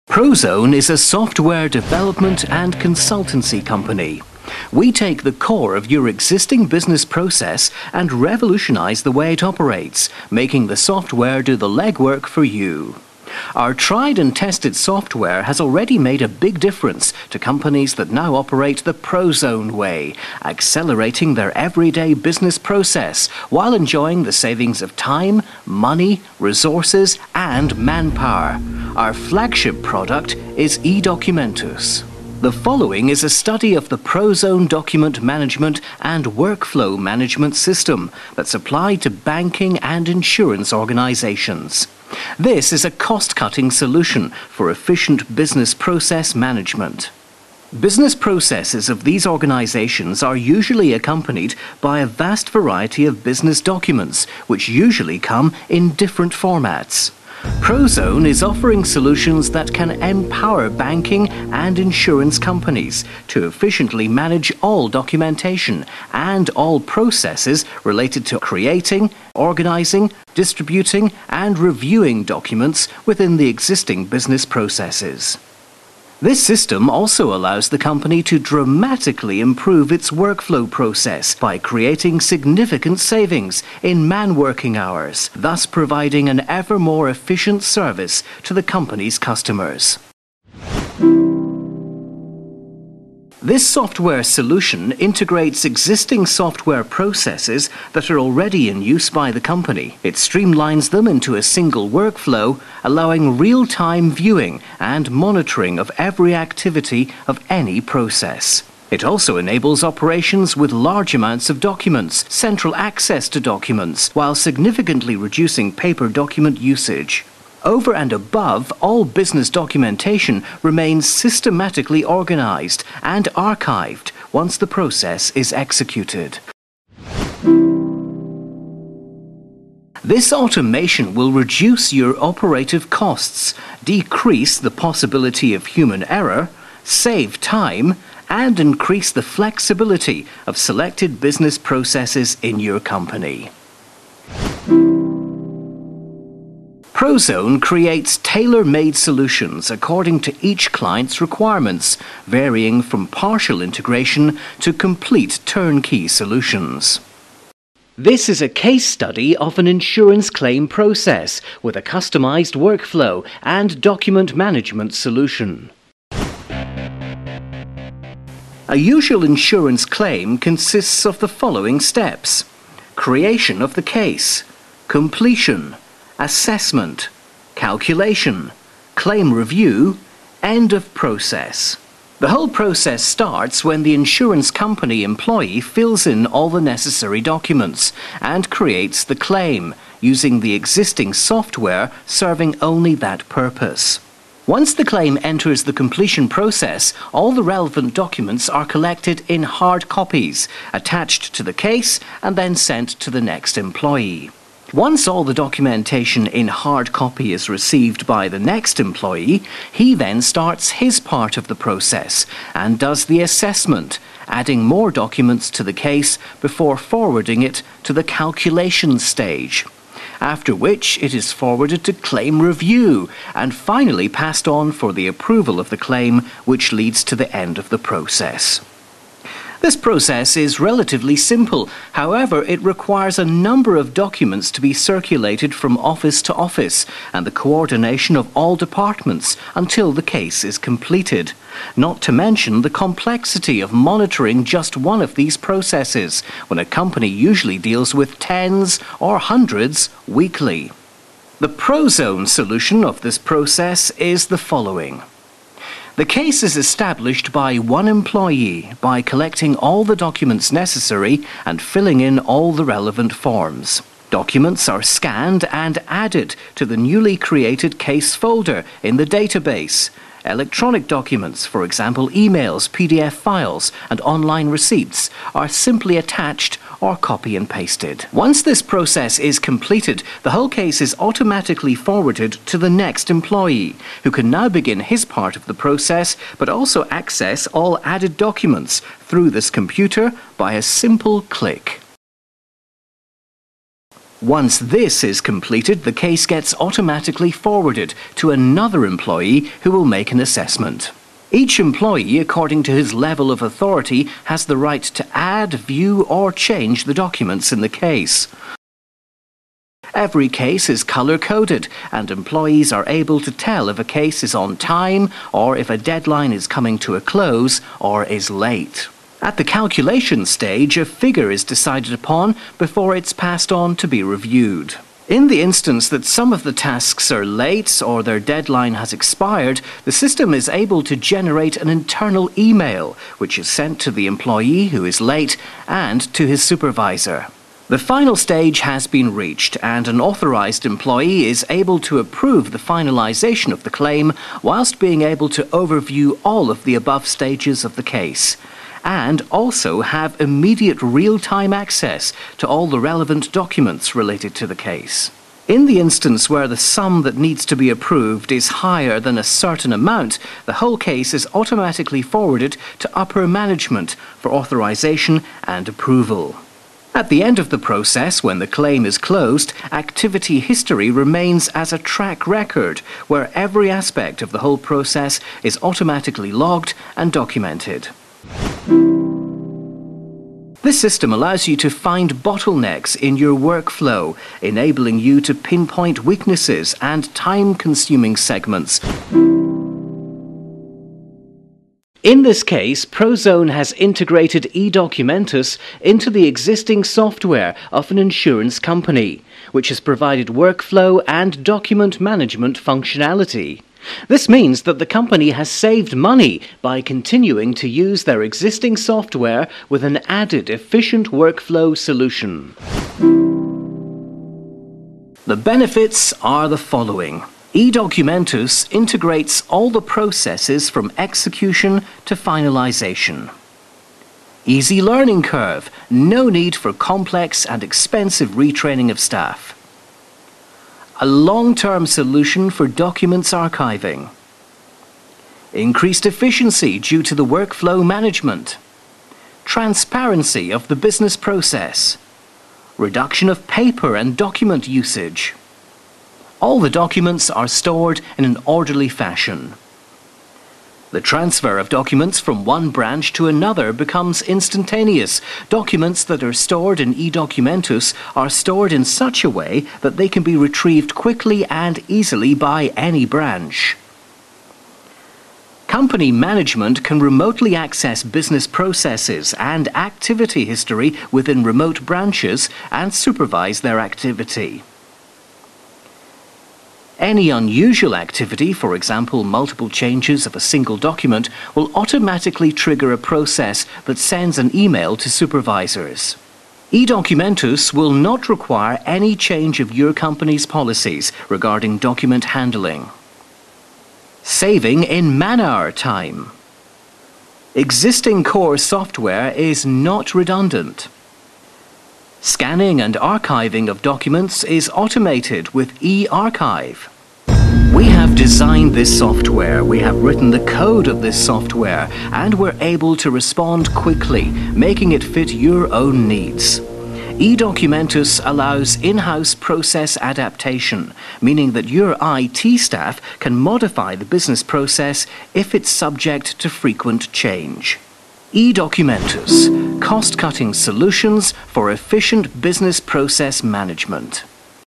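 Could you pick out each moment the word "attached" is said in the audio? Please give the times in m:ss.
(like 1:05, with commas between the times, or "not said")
3:20, 4:35.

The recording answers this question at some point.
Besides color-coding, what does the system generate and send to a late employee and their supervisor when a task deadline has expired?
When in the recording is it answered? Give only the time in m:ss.
5:31.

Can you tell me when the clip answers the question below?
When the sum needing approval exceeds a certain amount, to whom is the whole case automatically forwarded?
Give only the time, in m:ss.
6:02.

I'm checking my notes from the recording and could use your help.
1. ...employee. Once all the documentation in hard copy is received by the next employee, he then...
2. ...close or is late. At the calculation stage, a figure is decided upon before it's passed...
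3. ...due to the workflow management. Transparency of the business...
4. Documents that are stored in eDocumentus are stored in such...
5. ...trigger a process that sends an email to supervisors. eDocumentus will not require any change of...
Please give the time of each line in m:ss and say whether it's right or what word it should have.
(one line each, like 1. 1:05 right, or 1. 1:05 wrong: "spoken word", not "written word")
1. 3:23 right
2. 5:17 right
3. 7:16 right
4. 7:35 right
5. 8:02 right.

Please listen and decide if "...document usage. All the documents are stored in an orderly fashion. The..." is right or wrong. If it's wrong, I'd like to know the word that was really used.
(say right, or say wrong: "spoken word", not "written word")
right.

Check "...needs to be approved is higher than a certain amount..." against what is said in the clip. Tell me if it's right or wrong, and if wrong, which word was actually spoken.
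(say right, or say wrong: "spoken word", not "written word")
right.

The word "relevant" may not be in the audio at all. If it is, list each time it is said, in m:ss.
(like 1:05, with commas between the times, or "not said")
3:17, 4:22, 5:52.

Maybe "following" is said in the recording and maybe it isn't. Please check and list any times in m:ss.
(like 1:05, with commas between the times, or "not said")
0:32, 2:51, 4:14, 6:56.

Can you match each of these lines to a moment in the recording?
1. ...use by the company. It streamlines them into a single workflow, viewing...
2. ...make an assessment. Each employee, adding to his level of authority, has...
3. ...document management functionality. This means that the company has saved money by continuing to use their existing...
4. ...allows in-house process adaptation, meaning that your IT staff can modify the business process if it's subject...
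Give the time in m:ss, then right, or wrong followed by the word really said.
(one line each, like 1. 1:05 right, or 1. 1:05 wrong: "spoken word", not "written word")
1. 1:38 wrong: "allowing", not "viewing"
2. 4:59 wrong: "according", not "adding"
3. 6:41 right
4. 8:38 right.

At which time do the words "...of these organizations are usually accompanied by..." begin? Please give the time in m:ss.
0:48.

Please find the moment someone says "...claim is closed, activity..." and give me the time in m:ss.
6:08.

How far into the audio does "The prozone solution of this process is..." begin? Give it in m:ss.
4:11.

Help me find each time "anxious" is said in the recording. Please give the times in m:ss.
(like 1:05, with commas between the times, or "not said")
not said.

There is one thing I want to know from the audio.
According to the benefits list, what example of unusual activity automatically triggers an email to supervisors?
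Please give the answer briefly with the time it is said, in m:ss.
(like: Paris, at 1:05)
Multiple changes of a single document, at 7:59.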